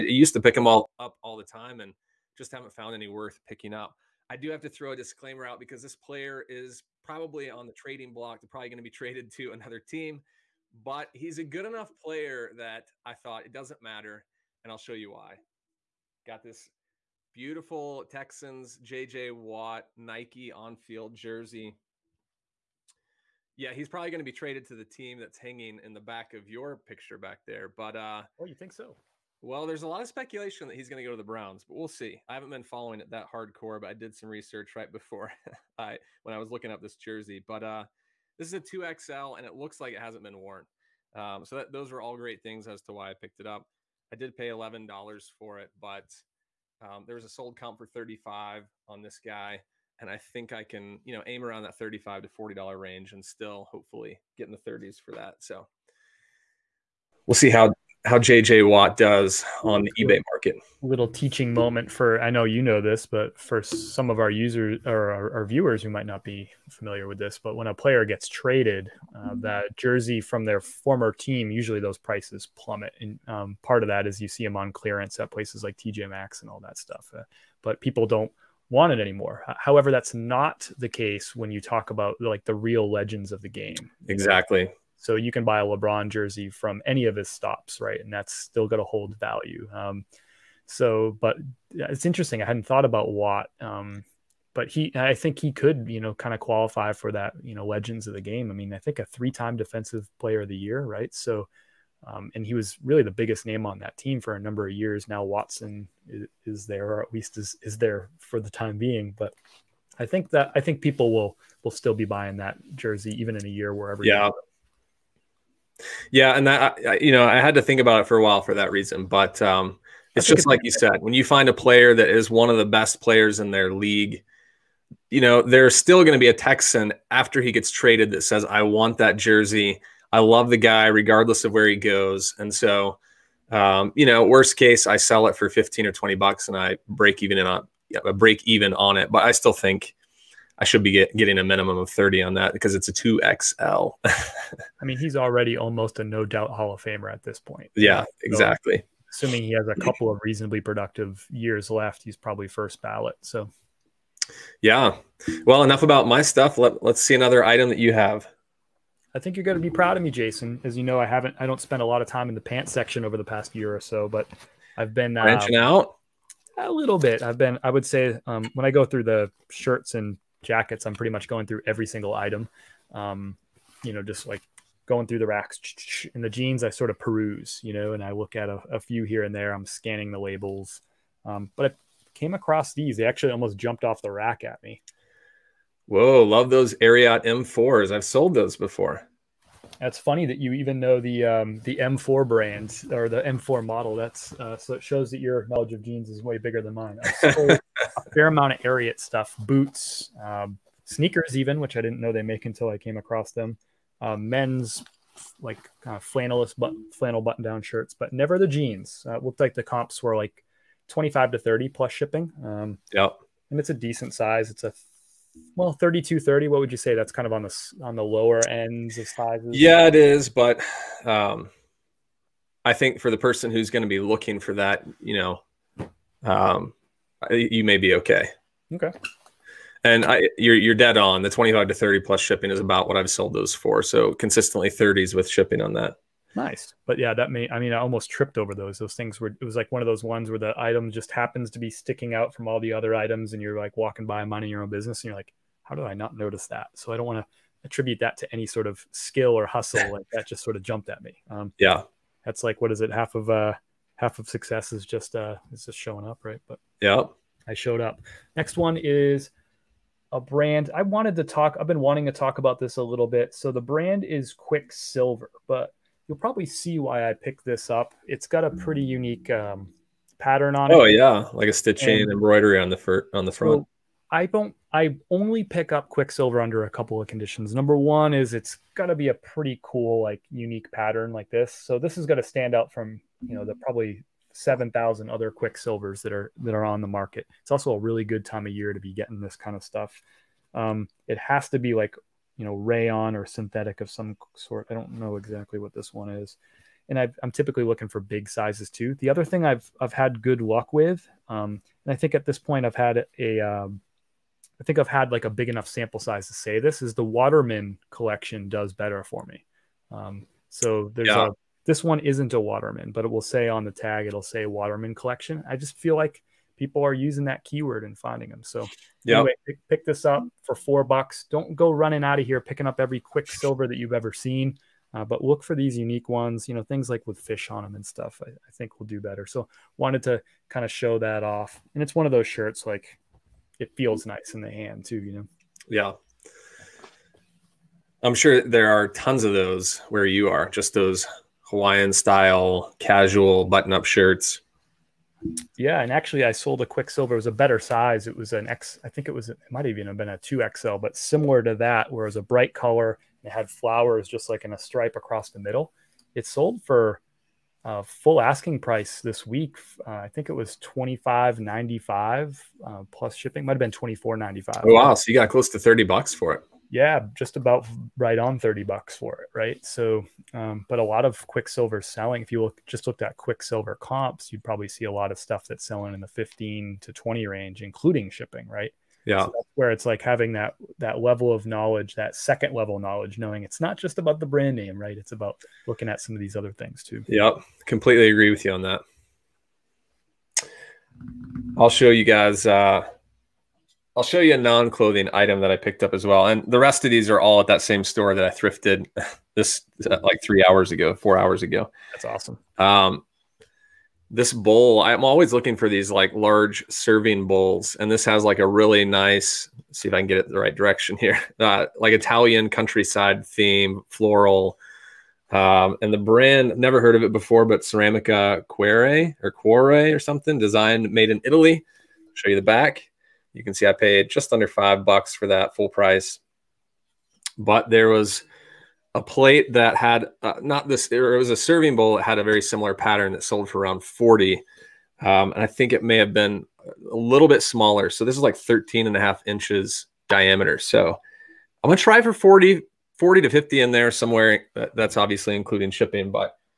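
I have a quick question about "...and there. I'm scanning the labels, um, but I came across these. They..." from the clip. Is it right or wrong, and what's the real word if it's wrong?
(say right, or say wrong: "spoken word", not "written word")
right.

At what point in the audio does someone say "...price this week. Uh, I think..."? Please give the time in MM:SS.
05:58.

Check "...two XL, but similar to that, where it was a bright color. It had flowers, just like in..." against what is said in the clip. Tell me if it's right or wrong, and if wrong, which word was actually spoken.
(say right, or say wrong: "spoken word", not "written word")
right.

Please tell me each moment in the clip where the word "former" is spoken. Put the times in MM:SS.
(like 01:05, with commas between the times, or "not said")
01:10.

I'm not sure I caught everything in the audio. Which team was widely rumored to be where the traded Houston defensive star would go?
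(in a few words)
Browns.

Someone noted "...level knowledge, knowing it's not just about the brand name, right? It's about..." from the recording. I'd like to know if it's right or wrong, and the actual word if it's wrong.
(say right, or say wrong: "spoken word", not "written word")
right.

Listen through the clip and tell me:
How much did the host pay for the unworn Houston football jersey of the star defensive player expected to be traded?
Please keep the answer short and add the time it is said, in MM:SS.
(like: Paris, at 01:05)
$11, at 00:44.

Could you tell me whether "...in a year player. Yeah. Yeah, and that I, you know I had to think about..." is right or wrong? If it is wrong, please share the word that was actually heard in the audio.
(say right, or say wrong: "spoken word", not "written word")
wrong: "wherever", not "player".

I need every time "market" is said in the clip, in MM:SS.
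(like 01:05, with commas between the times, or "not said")
01:00, 04:46.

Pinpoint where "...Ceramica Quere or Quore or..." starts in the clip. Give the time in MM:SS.
06:57.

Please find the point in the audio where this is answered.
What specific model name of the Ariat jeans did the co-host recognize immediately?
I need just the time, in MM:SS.
03:07.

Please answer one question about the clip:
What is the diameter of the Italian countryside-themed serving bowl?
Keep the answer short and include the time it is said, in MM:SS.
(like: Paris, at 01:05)
13.5 inches, at 07:18.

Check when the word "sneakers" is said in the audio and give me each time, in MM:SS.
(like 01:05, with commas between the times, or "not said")
03:20.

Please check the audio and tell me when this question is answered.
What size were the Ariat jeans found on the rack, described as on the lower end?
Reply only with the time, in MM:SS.
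03:35.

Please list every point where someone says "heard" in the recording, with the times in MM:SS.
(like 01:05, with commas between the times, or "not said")
06:56.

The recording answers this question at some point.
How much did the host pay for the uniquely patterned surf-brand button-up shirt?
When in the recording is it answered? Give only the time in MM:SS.
05:20.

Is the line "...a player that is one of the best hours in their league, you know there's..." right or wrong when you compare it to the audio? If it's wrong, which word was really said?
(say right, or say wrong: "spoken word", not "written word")
wrong: "players", not "hours".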